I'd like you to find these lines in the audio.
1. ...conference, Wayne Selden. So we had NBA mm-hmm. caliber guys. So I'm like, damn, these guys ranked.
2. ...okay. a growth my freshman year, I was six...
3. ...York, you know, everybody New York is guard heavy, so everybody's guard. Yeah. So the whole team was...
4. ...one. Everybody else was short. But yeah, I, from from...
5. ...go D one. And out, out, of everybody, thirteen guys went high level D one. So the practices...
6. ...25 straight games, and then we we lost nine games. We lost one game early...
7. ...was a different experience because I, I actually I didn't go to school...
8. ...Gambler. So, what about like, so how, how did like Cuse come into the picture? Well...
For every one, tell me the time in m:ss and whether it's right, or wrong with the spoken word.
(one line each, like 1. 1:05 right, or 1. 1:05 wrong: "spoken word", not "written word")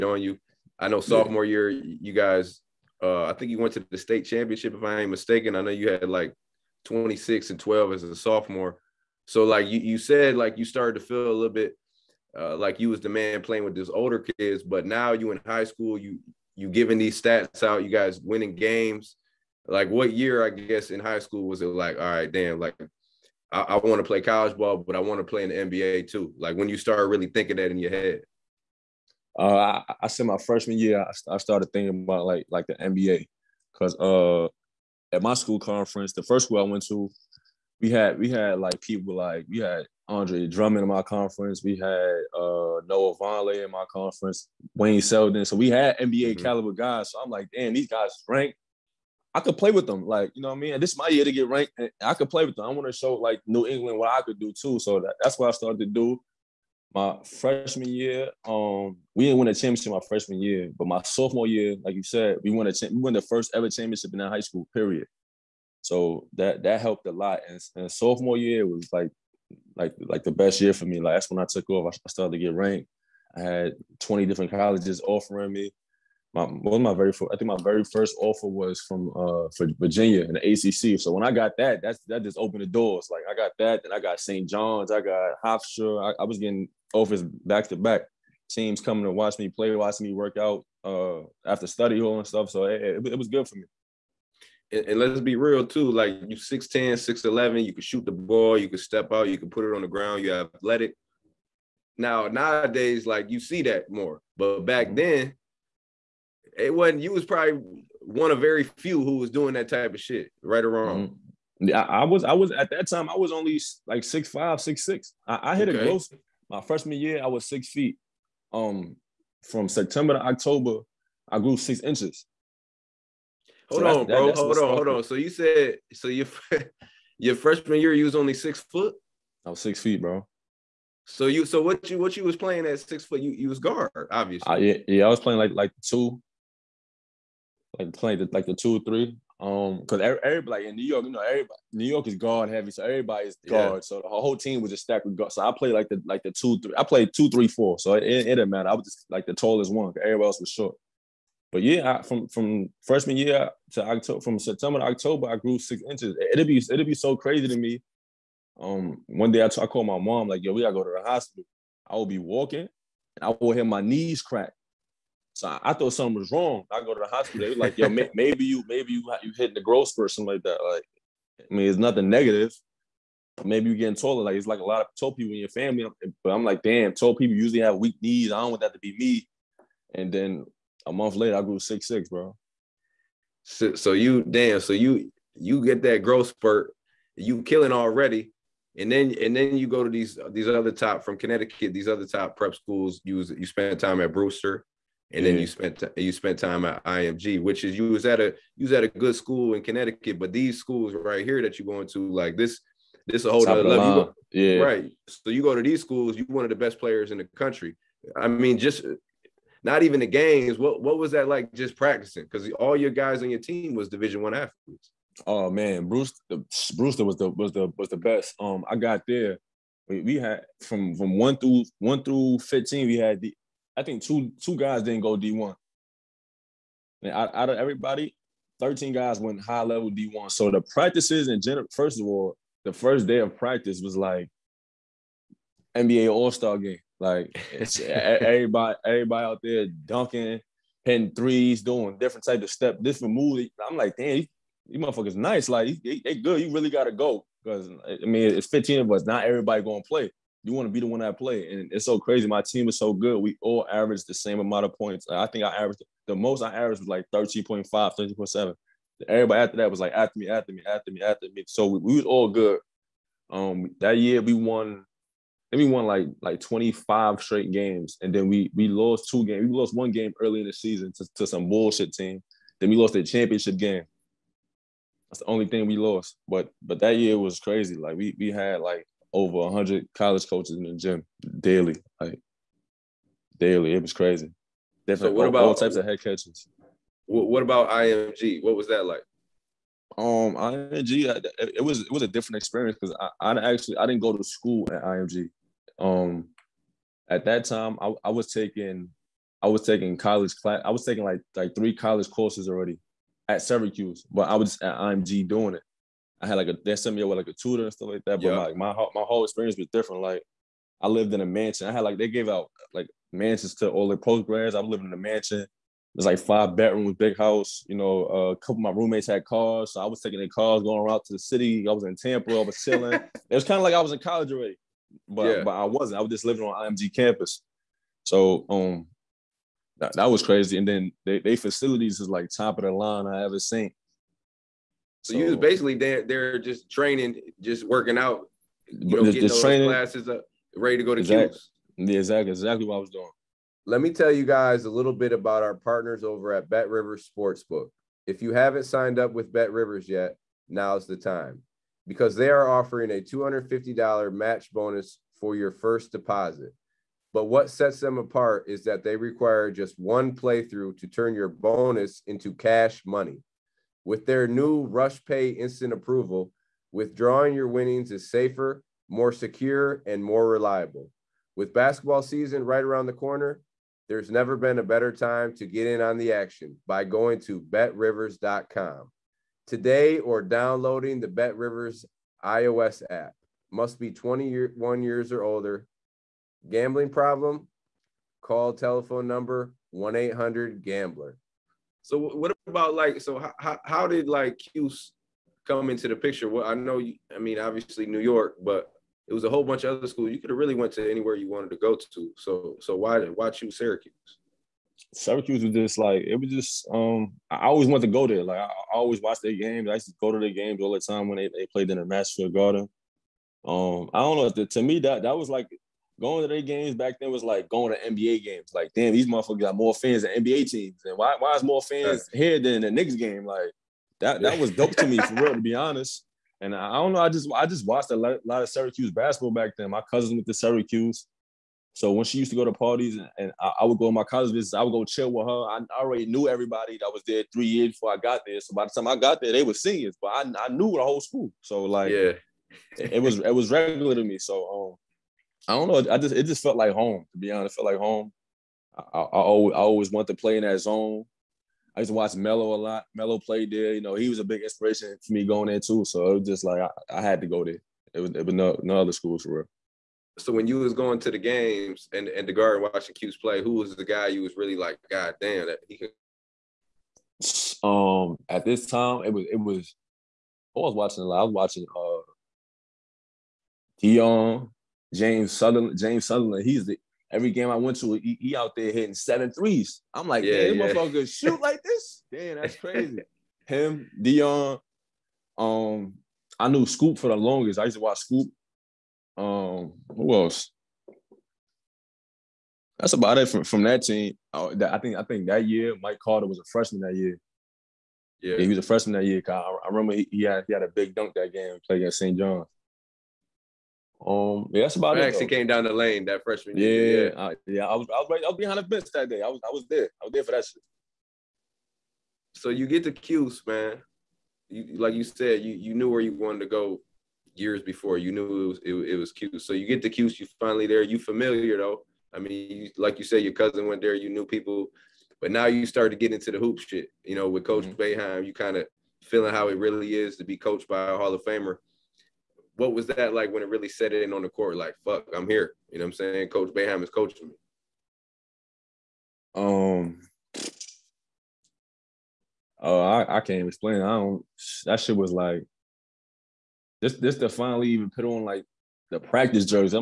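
1. 0:43 right
2. 1:55 right
3. 2:20 right
4. 2:29 right
5. 3:45 right
6. 4:26 wrong: "two", not "nine"
7. 4:51 right
8. 6:30 right.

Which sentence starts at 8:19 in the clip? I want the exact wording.
I, I remember he, he, had he had a big dunk that game.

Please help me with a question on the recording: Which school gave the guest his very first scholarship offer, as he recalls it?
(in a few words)
Virginia.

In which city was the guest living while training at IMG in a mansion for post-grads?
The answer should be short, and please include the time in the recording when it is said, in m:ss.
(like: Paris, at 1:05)
Tampa, at 5:21.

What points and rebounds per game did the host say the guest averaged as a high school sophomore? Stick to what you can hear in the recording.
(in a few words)
26 and 12.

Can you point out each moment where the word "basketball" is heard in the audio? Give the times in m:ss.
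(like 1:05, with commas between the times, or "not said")
6:11, 7:08.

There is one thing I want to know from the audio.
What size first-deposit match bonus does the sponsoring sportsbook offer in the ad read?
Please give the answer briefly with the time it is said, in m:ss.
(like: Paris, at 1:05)
$250, at 5:53.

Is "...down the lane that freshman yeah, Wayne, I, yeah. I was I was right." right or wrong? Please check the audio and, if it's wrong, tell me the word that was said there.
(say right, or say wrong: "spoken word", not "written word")
wrong: "Yeah", not "Wayne".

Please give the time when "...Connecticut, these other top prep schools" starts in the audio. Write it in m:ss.
3:11.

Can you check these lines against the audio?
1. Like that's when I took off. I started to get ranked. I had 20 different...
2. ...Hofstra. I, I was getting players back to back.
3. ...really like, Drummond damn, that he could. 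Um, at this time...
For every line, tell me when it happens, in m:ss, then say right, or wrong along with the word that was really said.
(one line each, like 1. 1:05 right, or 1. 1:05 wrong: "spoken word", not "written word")
1. 1:11 right
2. 1:25 wrong: "offers", not "players"
3. 7:44 wrong: "God", not "Drummond".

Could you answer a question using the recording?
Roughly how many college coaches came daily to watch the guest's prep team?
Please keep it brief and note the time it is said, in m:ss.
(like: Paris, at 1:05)
over 100, at 4:39.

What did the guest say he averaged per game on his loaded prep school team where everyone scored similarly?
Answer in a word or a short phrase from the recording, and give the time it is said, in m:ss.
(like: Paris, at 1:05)
13.5, at 4:17.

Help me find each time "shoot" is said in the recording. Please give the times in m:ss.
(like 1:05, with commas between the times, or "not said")
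1:37, 8:01.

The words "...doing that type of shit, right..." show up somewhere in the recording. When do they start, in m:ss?
1:49.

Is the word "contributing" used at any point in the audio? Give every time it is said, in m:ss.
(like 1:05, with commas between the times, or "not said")
not said.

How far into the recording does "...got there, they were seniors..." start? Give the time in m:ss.
7:18.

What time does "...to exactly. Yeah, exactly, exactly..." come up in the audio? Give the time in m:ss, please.
5:40.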